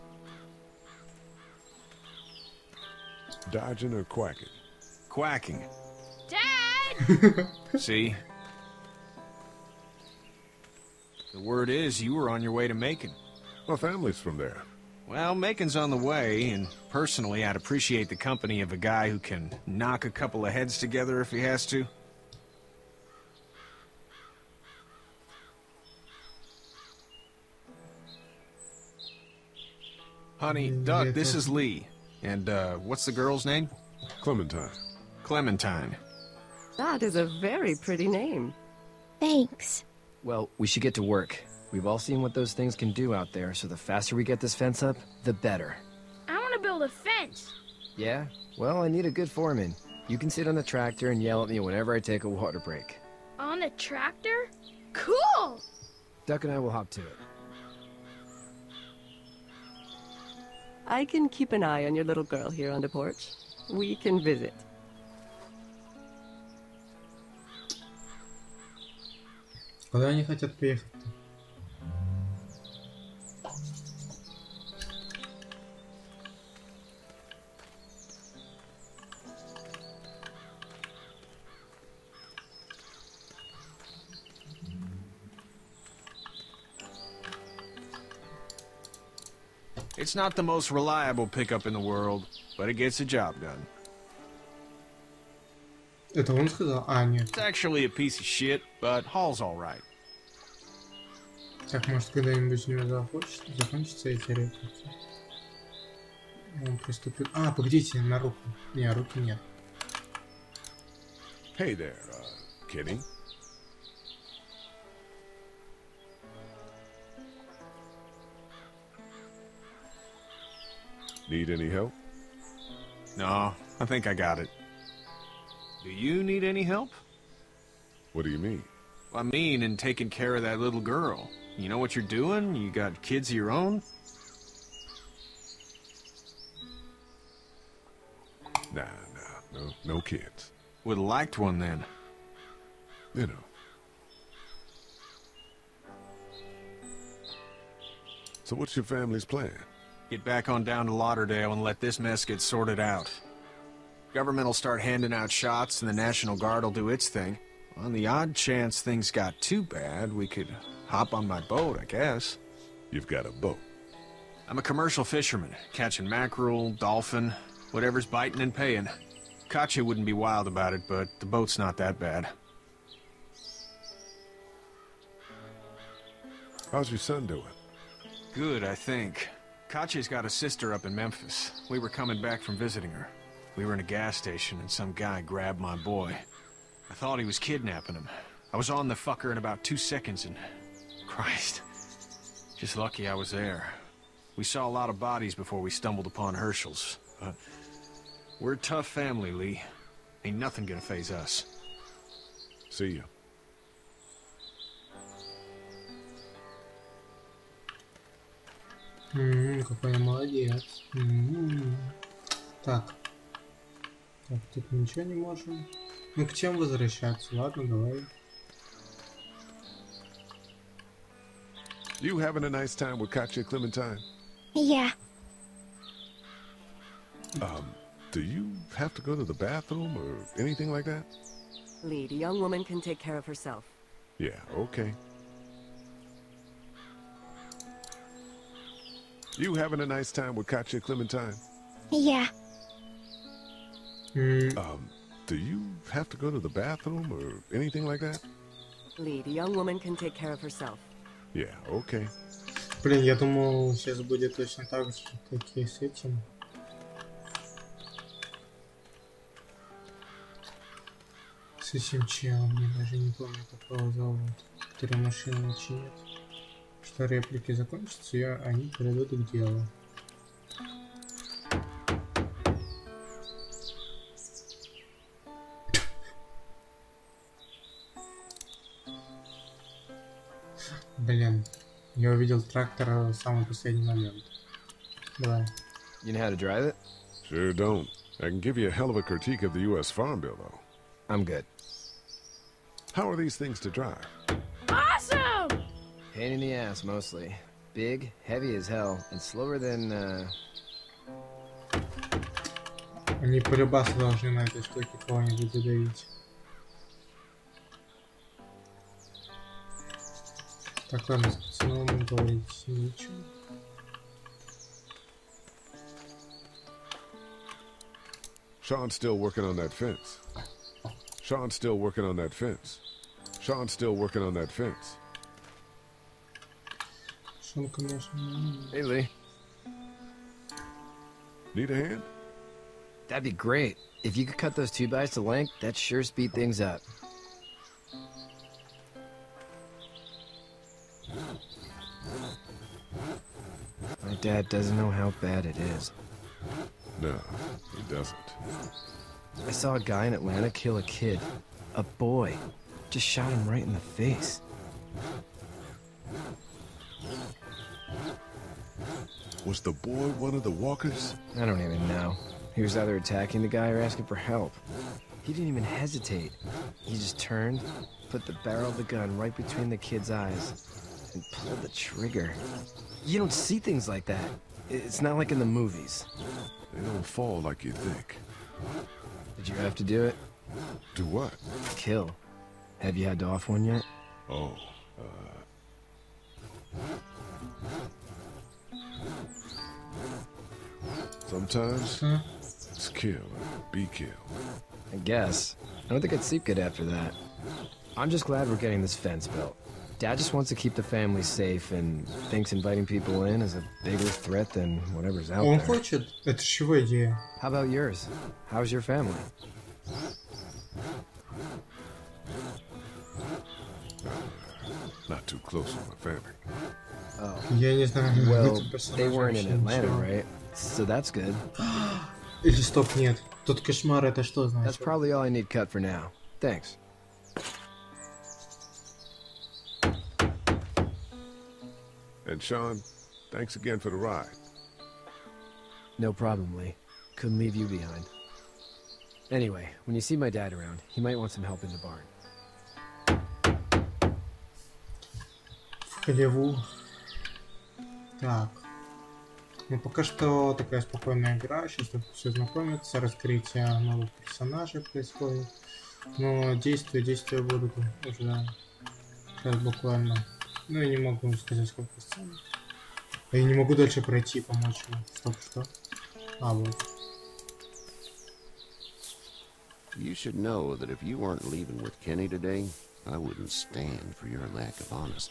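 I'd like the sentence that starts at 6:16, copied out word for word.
They don't fall like you think.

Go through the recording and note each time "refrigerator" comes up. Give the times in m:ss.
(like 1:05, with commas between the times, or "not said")
not said.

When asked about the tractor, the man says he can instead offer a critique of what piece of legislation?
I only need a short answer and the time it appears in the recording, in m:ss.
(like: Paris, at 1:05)
U.S. Farm Bill, at 4:49.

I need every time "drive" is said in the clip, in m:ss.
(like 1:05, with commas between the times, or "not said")
4:46, 4:53.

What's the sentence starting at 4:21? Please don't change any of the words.
С этим челом, я даже не помню, какого зовут, который машину чинит.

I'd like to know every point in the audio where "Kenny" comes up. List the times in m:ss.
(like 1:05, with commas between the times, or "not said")
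1:52, 7:52.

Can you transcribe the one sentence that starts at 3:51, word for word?
Lead, the young woman can take care of herself.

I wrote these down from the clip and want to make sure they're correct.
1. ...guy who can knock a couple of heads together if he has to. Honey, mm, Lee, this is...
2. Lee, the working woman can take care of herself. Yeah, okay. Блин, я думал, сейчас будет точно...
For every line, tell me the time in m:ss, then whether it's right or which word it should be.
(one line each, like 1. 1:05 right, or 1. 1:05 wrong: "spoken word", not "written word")
1. 0:18 wrong: "Doug", not "Lee"
2. 4:08 wrong: "young", not "working".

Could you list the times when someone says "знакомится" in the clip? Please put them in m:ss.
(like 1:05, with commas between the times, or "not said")
7:32.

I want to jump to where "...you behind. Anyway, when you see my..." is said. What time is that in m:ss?
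7:17.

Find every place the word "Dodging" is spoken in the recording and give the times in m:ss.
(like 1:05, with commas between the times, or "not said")
0:03.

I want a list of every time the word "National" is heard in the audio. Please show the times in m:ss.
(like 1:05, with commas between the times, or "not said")
2:35.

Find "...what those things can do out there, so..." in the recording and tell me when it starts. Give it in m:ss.
0:42.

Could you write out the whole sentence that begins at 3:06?
I thought he was kidnapping him.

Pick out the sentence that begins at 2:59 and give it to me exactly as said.
Katjaa's got a sister up in Memphis.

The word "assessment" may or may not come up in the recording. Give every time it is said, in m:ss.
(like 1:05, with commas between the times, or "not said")
not said.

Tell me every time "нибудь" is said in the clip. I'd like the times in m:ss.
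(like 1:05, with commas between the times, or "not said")
1:42, 5:05.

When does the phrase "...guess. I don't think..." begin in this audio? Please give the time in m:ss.
6:34.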